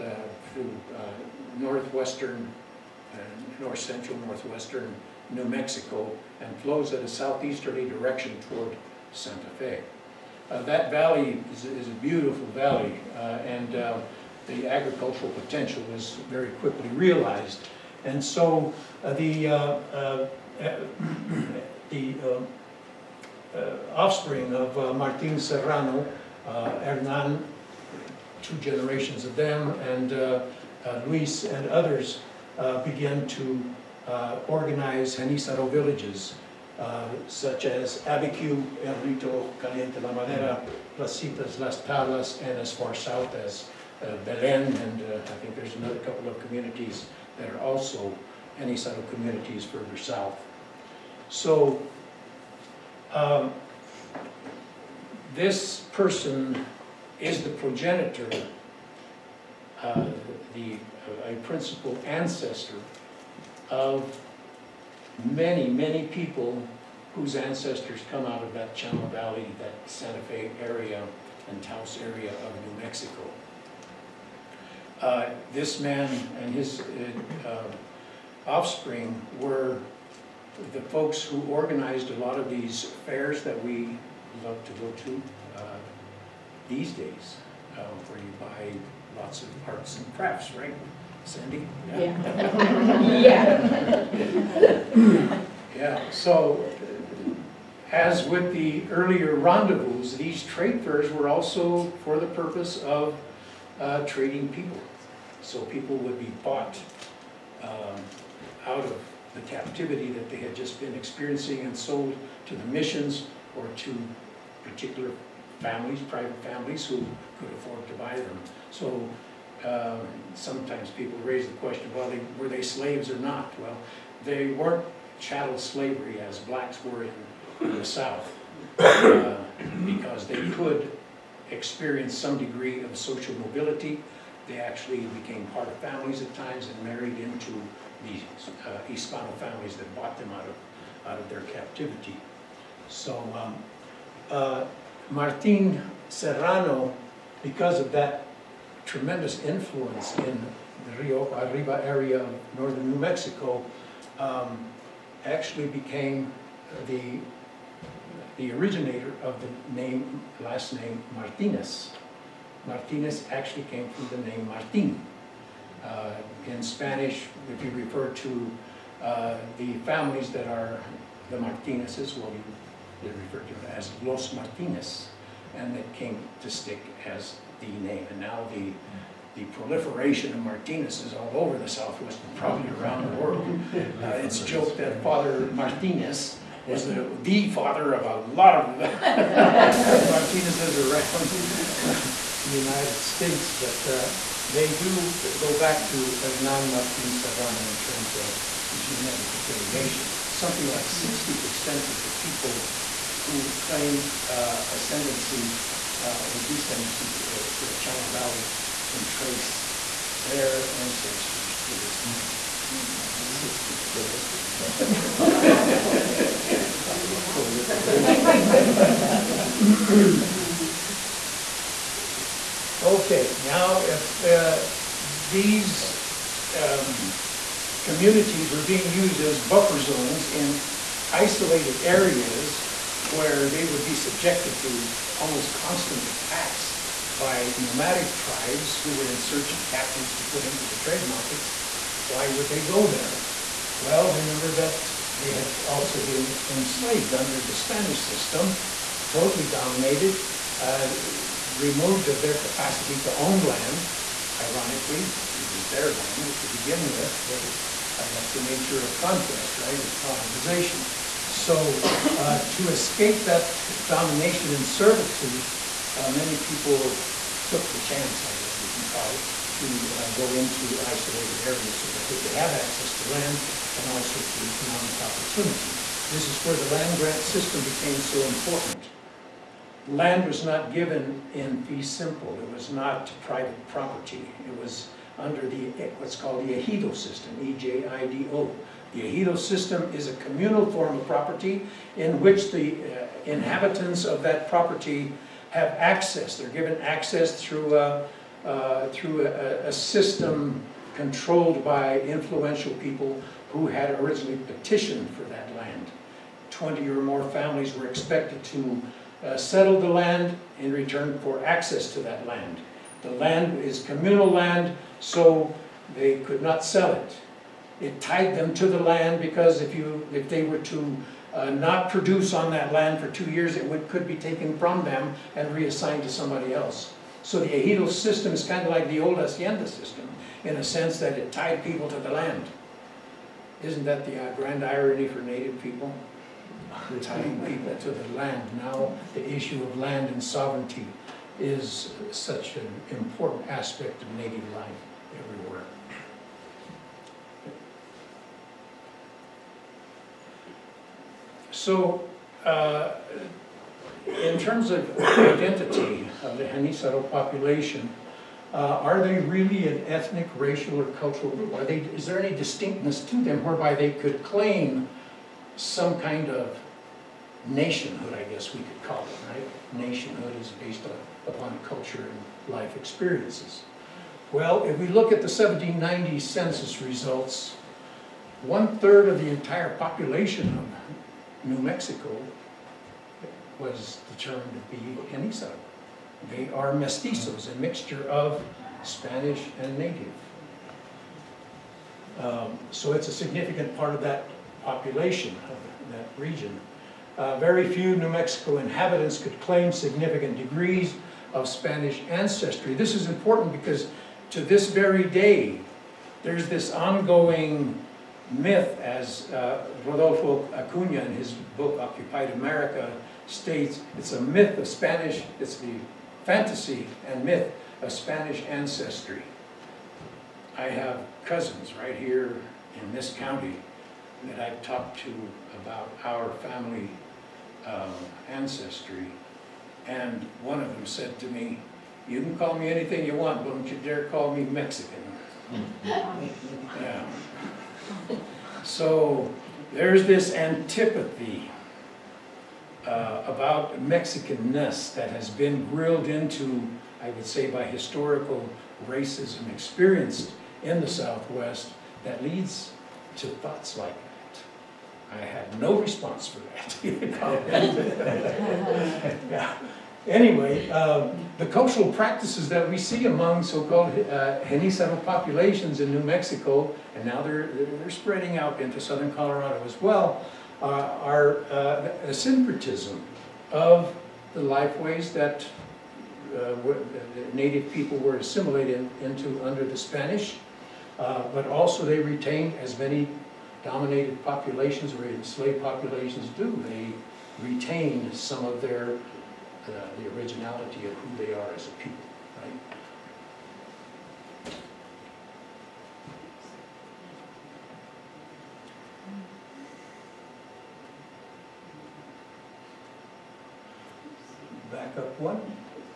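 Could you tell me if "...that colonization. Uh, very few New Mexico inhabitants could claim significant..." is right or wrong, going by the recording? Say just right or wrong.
wrong.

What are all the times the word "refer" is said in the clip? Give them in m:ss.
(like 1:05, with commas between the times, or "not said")
2:47, 2:53.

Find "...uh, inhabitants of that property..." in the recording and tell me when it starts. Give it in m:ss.
4:52.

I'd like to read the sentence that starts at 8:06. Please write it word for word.
They retain some of their, uh, the originality of who they are as a people, right?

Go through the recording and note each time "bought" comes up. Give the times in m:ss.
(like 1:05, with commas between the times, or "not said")
1:46, 2:19.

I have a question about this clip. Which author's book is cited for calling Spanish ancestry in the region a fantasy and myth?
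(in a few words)
Rodolfo Acuna.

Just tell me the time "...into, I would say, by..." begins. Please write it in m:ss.
7:26.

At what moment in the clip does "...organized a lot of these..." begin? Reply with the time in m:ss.
1:21.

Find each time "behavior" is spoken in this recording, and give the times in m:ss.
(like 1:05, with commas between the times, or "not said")
not said.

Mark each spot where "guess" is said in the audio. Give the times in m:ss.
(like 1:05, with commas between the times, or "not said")
4:28, 6:08.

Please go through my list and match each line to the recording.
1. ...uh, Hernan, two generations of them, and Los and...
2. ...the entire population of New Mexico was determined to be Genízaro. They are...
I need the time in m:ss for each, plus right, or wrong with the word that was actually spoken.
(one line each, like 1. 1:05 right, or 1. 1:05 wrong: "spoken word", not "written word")
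1. 0:26 wrong: "Luis", not "Los"
2. 6:19 right.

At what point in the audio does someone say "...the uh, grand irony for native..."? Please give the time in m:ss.
5:34.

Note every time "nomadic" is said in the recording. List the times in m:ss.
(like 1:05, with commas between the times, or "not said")
3:57.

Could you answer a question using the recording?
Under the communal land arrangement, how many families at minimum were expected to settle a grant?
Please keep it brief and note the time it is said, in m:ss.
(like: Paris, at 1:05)
20, at 5:06.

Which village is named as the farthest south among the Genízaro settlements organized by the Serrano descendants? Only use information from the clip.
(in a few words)
Belen.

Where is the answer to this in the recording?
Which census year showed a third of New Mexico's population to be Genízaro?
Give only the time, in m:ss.
6:15.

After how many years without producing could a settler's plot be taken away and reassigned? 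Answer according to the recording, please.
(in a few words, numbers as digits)
2.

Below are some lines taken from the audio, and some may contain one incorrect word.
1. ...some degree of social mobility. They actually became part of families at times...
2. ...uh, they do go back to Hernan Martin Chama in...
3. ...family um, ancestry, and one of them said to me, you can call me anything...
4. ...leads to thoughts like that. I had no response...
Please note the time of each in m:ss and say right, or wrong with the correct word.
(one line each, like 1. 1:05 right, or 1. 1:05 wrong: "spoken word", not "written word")
1. 2:12 right
2. 3:13 wrong: "Serrano", not "Chama"
3. 7:06 right
4. 7:32 right.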